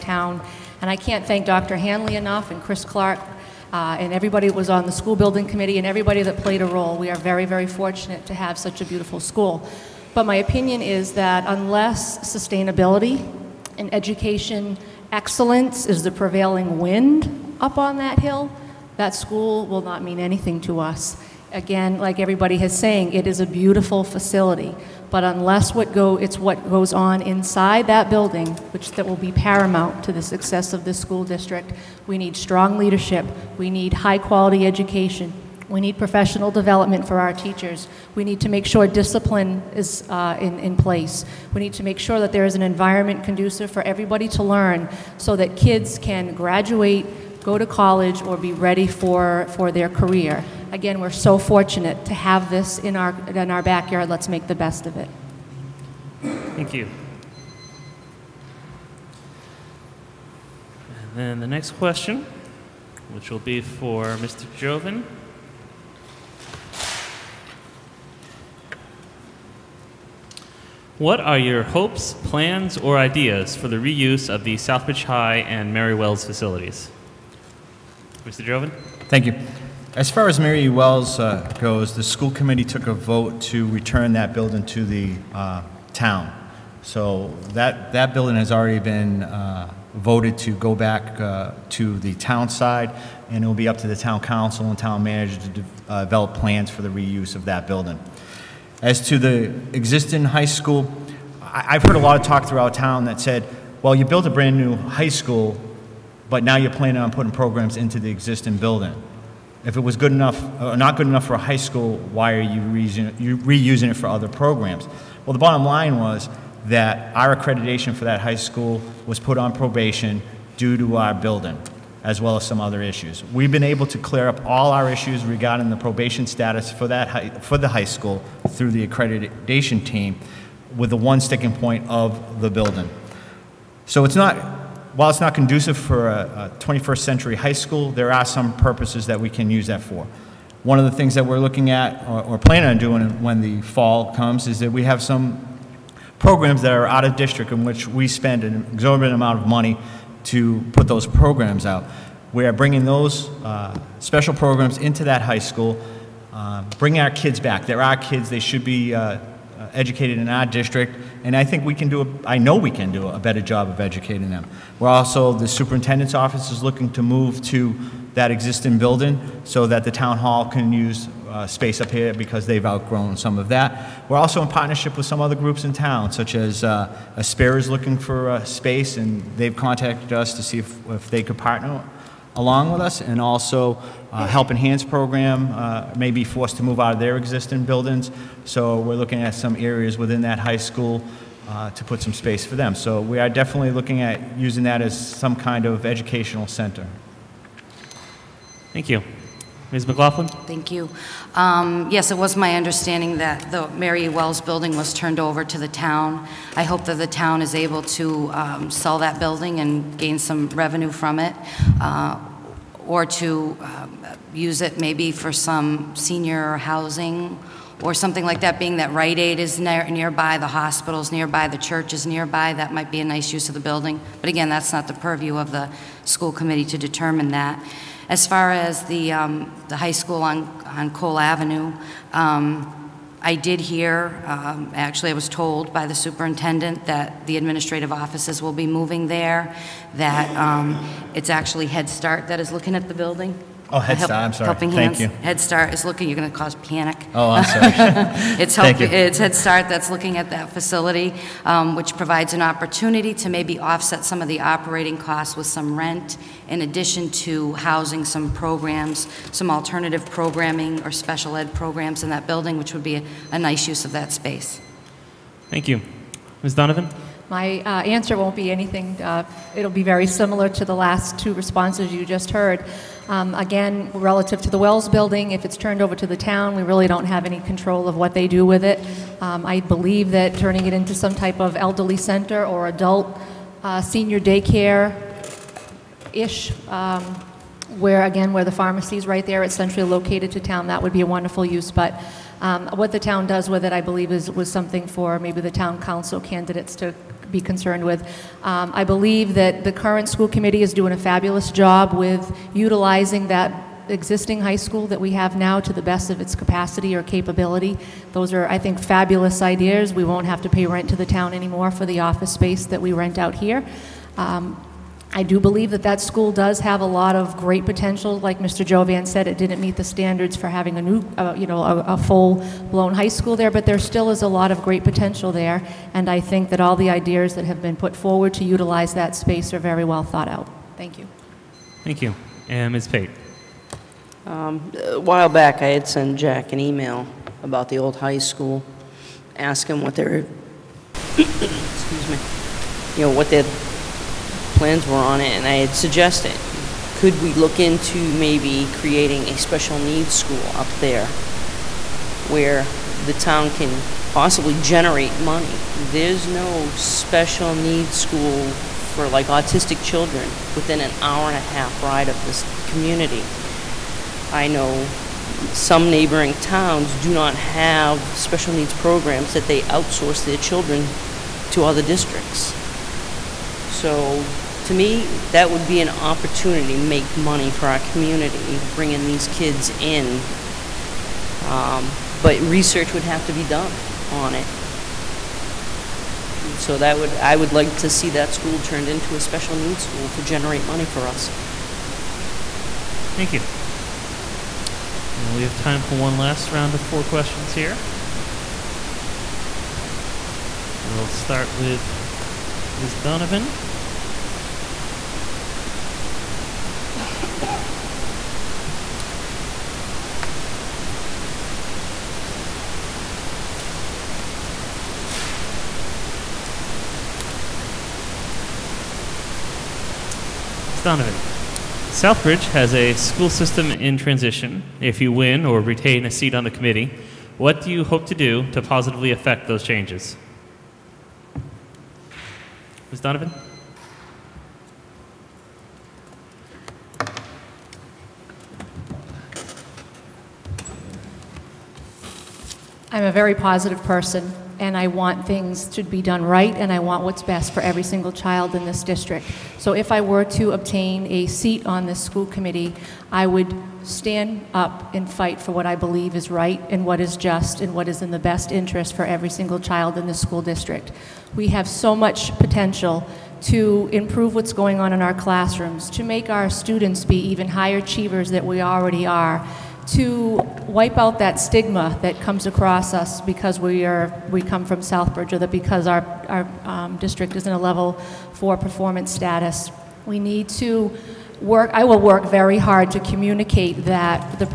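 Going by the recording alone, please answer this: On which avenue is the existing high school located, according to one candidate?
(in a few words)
Cole Avenue.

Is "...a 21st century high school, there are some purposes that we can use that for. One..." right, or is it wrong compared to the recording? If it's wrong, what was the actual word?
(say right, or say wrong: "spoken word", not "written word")
right.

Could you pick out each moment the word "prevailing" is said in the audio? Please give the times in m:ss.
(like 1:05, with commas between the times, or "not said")
0:16.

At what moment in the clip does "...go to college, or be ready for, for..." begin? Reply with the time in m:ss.
0:47.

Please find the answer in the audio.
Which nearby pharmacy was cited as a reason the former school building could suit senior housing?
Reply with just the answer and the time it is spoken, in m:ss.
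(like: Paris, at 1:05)
Rite Aid, at 3:38.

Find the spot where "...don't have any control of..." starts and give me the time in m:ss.
4:36.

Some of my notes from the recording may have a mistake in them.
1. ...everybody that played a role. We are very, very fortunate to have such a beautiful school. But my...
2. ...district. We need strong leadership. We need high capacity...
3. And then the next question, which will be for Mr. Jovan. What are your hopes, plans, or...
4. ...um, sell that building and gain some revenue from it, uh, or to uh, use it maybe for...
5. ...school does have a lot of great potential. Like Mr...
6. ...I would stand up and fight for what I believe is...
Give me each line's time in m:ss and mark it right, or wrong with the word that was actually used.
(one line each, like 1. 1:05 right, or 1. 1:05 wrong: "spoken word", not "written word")
1. 0:05 right
2. 0:31 wrong: "quality", not "capacity"
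3. 1:01 right
4. 3:28 right
5. 5:16 right
6. 7:33 right.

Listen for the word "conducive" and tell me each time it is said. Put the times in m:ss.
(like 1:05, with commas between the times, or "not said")
0:43, 2:15.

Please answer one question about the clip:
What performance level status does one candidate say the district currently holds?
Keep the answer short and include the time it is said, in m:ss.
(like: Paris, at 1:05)
Level four, at 7:57.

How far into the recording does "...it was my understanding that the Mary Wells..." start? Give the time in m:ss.
3:22.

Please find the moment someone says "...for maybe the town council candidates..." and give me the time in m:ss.
4:54.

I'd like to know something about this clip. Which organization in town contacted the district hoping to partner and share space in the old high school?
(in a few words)
Aspera.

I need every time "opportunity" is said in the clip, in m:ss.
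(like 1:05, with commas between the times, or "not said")
4:12, 6:15.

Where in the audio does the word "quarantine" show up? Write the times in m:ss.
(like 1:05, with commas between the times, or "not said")
not said.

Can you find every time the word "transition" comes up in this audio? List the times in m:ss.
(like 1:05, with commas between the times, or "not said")
7:03.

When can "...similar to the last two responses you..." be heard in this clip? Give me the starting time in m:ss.
4:30.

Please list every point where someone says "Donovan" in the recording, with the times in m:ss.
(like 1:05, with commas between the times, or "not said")
4:26, 6:42, 7:00, 7:13.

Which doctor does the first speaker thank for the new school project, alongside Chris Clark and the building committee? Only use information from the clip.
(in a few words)
Dr. Hanley.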